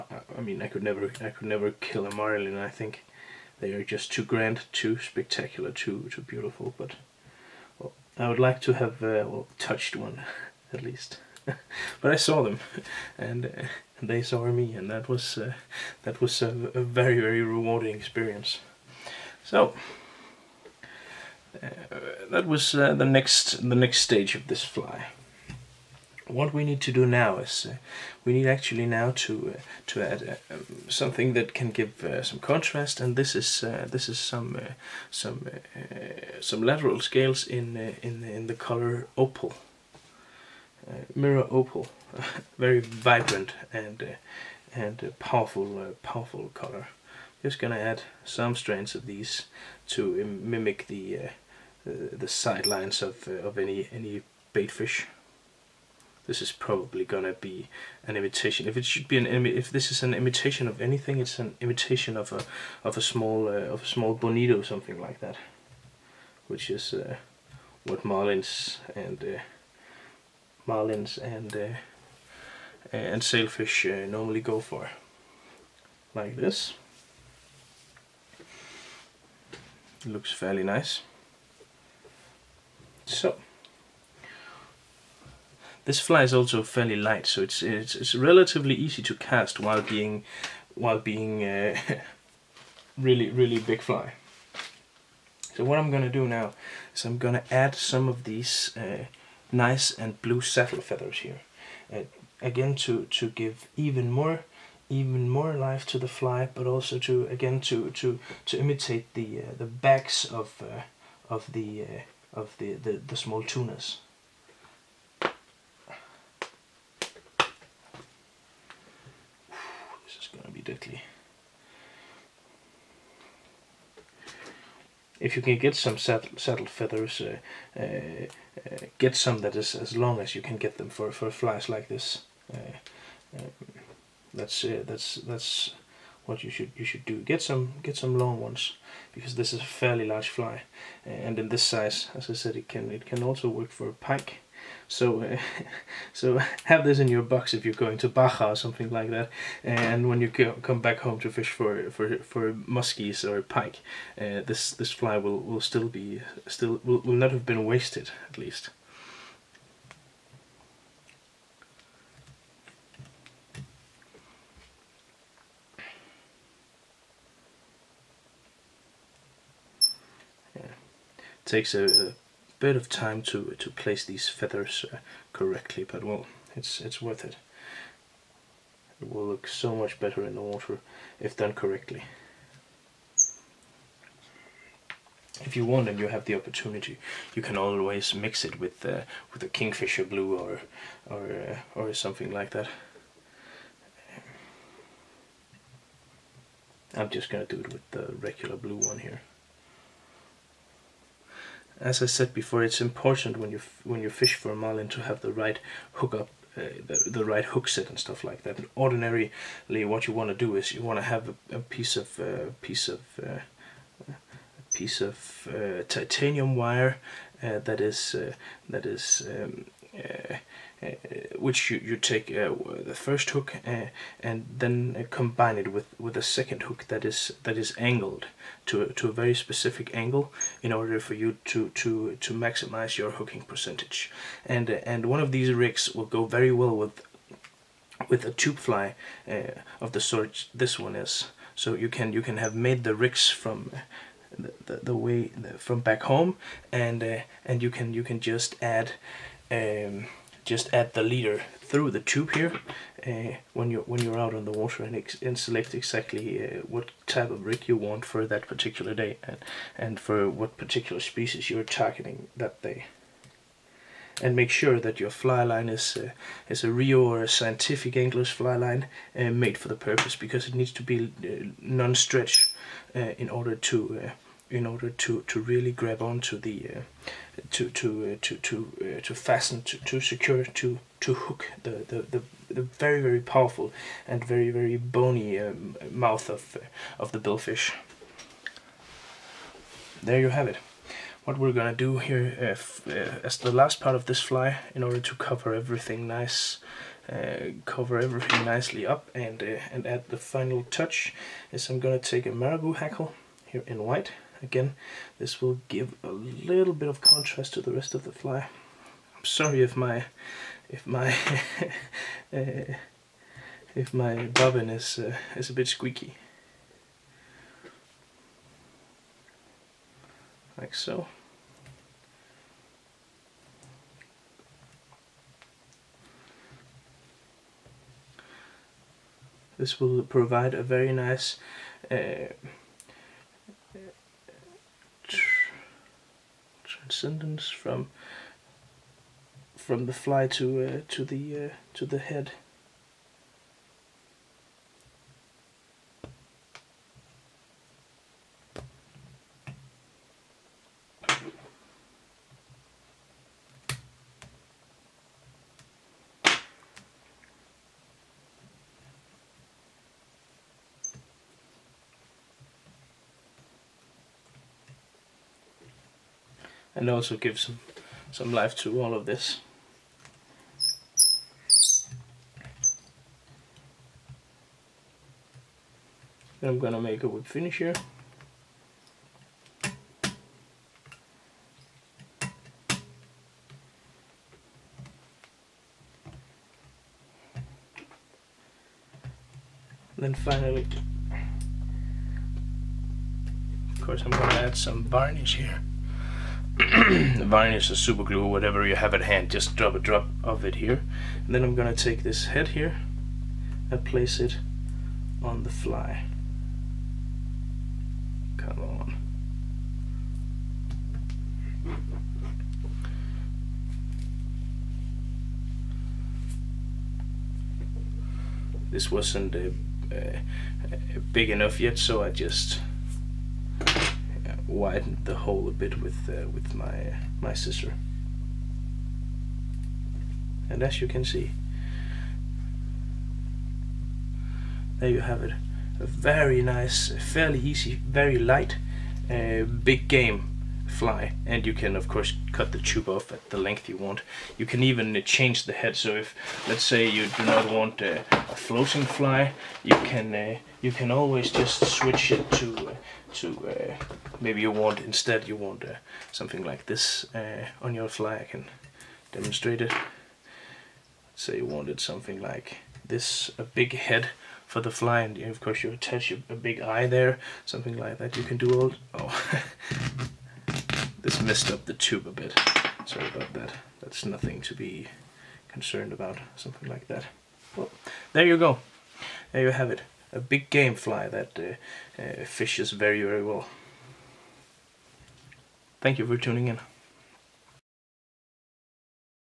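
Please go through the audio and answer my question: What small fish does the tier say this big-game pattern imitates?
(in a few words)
bonito.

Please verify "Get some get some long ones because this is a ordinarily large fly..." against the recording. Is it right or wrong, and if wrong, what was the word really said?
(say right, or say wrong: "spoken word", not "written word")
wrong: "fairly", not "ordinarily".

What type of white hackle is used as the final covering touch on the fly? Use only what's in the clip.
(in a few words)
marabou.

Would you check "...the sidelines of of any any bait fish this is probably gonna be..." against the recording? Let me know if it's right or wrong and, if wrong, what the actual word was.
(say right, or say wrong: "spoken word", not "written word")
right.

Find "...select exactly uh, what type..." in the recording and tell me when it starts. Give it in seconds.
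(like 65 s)
255 s.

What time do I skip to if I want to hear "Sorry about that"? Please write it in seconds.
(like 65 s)
472 s.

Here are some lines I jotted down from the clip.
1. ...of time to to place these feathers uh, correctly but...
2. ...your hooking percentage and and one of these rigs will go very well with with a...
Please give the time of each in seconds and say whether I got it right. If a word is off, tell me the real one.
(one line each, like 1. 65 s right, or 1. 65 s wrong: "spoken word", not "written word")
1. 172 s right
2. 232 s right.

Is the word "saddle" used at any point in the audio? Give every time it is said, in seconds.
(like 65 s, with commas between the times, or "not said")
100 s, 125 s.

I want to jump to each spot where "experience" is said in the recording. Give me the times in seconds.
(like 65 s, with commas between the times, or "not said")
17 s.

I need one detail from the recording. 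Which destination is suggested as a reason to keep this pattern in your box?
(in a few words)
Baja.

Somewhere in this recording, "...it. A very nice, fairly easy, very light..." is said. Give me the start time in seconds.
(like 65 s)
435 s.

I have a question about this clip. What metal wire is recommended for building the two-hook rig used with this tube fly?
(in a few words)
titanium.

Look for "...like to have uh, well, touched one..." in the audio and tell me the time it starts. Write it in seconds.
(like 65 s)
8 s.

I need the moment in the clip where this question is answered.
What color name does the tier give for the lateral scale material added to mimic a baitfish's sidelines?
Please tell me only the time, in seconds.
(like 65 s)
39 s.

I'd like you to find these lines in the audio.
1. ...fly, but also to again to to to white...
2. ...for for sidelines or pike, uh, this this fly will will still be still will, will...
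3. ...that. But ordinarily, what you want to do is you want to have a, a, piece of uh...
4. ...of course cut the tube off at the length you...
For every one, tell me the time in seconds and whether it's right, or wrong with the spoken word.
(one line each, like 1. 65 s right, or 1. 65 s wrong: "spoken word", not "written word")
1. 106 s wrong: "imitate", not "white"
2. 151 s wrong: "muskies", not "sidelines"
3. 208 s right
4. 441 s right.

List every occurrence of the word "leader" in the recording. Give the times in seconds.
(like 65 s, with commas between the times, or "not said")
251 s.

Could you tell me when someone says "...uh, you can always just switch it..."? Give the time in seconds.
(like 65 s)
450 s.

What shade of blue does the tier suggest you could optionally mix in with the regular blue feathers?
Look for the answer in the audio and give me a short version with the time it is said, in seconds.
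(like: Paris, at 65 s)
kingfisher blue, at 189 s.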